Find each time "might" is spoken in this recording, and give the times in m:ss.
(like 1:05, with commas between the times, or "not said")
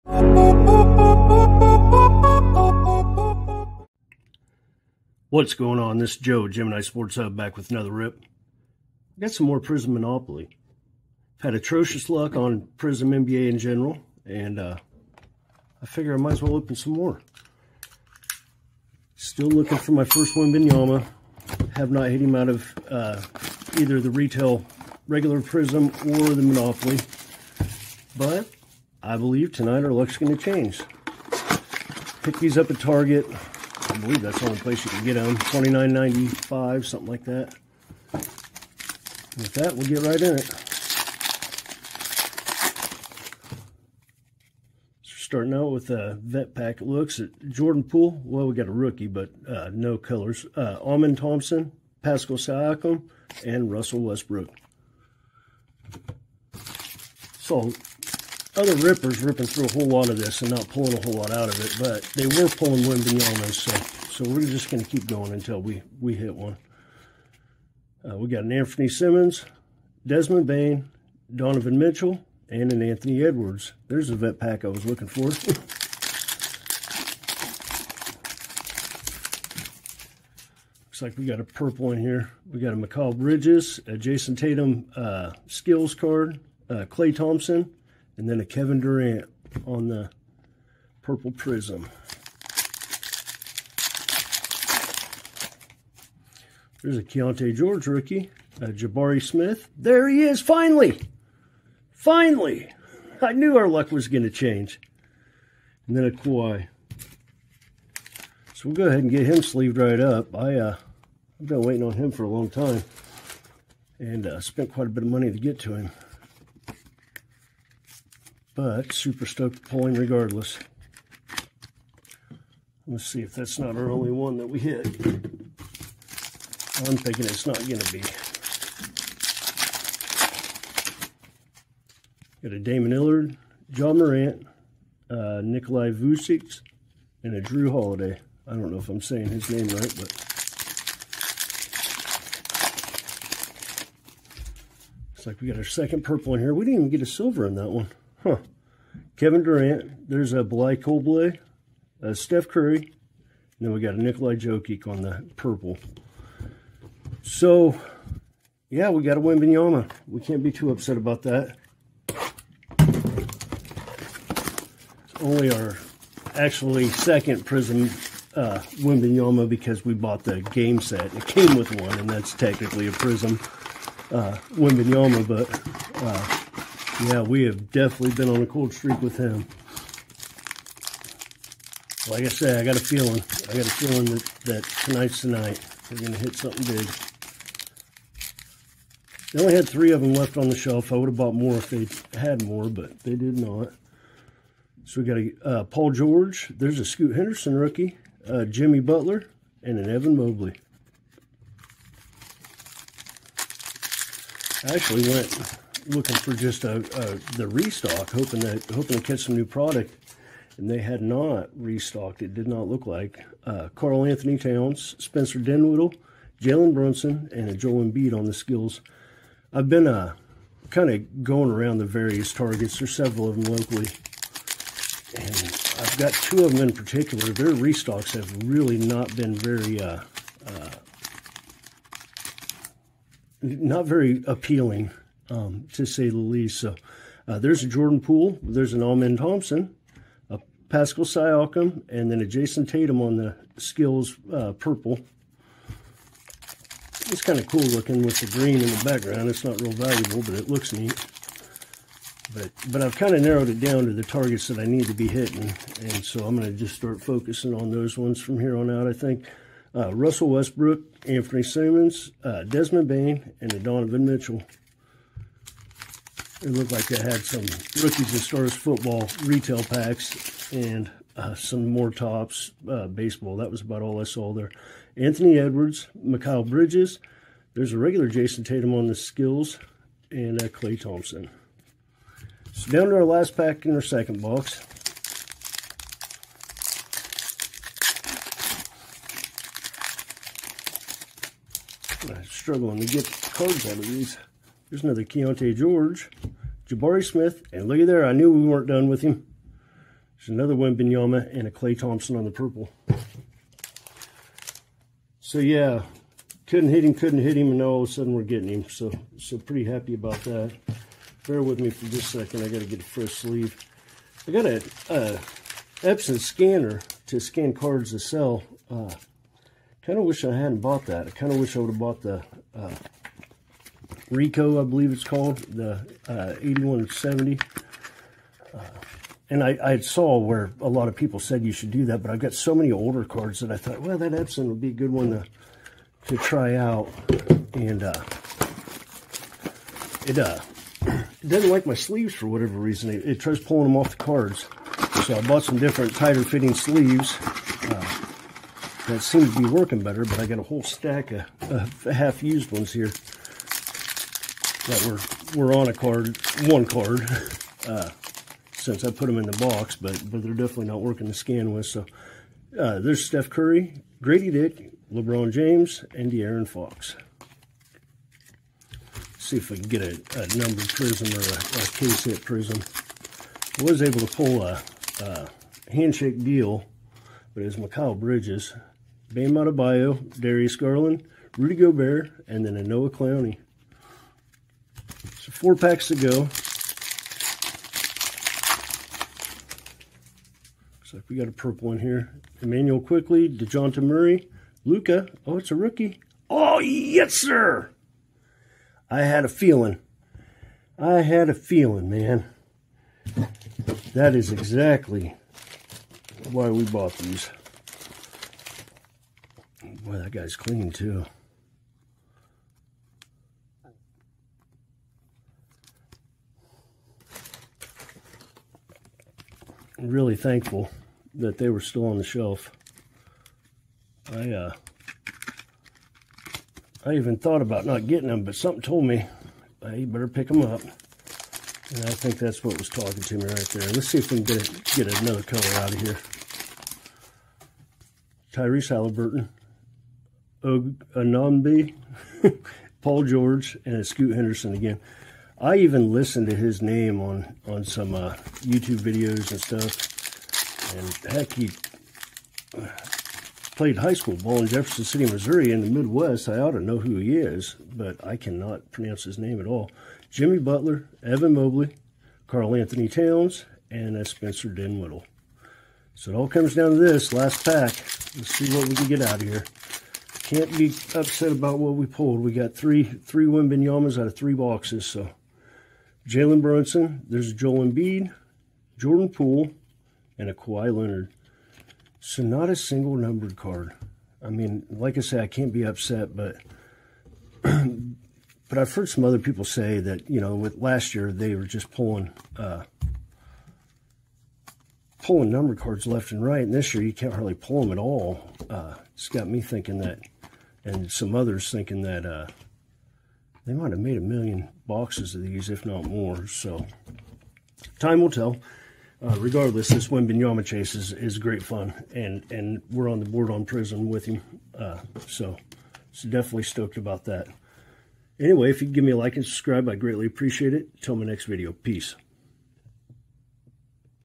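0:16, 8:23.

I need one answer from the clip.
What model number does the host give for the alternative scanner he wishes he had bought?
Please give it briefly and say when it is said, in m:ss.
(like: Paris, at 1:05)
8170, at 5:26.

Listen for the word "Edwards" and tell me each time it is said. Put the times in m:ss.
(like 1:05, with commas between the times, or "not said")
1:13, 4:35.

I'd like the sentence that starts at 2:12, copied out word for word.
Got a Damian Lillard, John Morant, uh, Nikolai Vucic, and a Drew Holiday.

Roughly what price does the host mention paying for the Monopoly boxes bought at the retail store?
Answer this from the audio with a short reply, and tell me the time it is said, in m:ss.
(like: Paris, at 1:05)
$29.95, at 0:35.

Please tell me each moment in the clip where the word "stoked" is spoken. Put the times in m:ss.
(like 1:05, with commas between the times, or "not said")
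1:59, 8:36.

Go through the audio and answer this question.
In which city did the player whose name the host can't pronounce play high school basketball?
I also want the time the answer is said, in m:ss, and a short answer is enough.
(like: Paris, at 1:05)
Jefferson City, Missouri, at 7:34.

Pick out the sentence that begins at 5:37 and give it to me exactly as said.
And uh, it, uh, it doesn't like my sleeves for whatever reason.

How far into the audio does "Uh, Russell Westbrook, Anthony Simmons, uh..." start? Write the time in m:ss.
4:19.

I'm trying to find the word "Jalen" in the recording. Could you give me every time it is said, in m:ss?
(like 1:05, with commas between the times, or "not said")
3:36, 7:56.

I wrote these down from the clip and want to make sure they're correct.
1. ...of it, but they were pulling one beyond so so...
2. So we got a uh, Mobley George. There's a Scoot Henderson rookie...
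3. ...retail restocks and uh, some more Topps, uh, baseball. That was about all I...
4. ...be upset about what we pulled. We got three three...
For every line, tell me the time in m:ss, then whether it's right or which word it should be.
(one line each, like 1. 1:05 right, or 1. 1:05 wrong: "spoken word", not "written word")
1. 1:01 right
2. 3:14 wrong: "Paul", not "Mobley"
3. 4:29 wrong: "packs", not "restocks"
4. 7:50 right.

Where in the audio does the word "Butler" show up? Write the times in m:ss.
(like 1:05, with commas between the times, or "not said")
3:18, 7:40.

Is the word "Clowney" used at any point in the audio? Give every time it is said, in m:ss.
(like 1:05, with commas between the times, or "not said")
6:22.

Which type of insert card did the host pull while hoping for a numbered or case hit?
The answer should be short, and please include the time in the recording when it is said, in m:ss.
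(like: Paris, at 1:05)
handshake, at 6:15.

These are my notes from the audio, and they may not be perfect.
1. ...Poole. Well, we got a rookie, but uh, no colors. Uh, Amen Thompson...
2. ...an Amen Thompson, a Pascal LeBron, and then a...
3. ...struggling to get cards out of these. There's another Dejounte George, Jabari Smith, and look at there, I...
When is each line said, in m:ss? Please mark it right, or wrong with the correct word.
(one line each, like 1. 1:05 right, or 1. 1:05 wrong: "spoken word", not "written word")
1. 0:47 right
2. 3:58 wrong: "Siakam", not "LeBron"
3. 4:52 wrong: "Keyonte", not "Dejounte".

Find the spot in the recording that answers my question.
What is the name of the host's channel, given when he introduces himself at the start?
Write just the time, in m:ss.
0:06.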